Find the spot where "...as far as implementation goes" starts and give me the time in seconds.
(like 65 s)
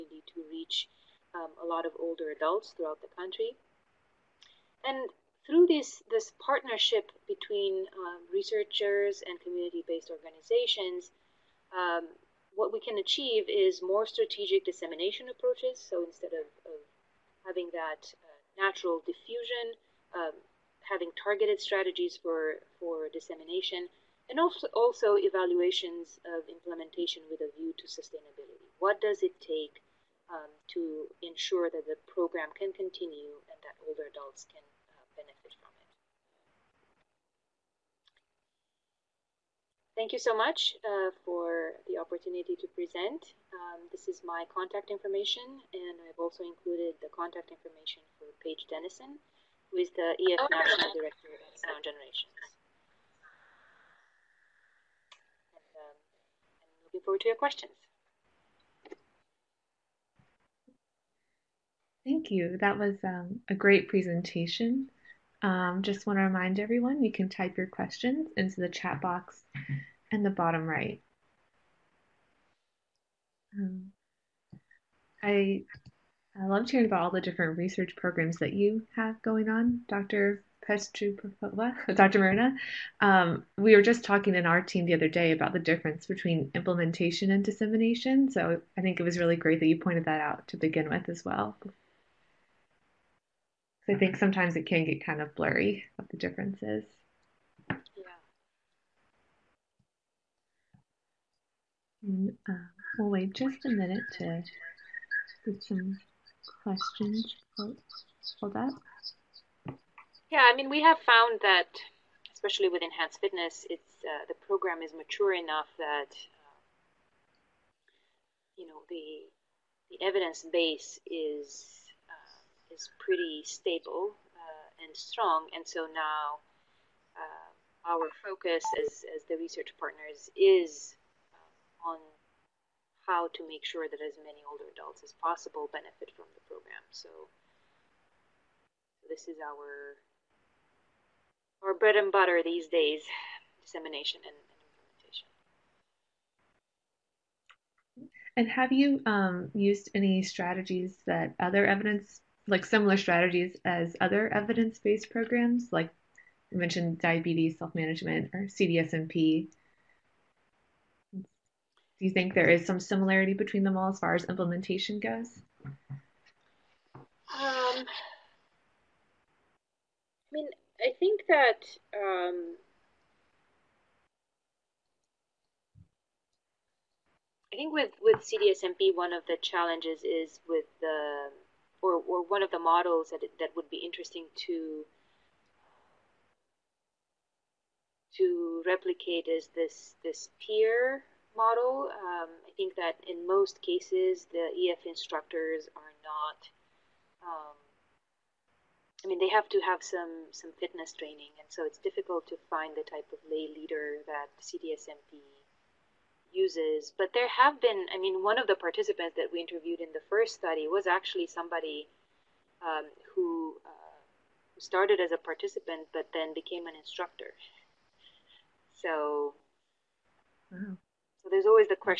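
163 s.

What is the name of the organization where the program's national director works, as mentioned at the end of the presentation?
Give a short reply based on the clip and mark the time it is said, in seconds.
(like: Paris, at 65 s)
Sound Generations, at 51 s.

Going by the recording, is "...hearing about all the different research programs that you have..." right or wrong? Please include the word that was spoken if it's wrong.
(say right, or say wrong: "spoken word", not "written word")
right.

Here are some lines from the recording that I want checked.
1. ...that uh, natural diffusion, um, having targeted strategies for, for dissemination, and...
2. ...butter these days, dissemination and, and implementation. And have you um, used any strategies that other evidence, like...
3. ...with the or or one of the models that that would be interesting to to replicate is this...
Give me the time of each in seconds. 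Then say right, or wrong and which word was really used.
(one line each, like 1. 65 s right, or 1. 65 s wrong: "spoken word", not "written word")
1. 17 s right
2. 142 s right
3. 180 s right.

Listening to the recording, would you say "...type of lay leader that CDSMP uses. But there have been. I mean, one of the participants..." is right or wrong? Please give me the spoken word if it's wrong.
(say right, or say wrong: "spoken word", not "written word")
right.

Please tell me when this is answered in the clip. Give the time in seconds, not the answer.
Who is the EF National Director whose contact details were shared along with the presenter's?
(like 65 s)
48 s.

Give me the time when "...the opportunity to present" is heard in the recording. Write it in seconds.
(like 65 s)
41 s.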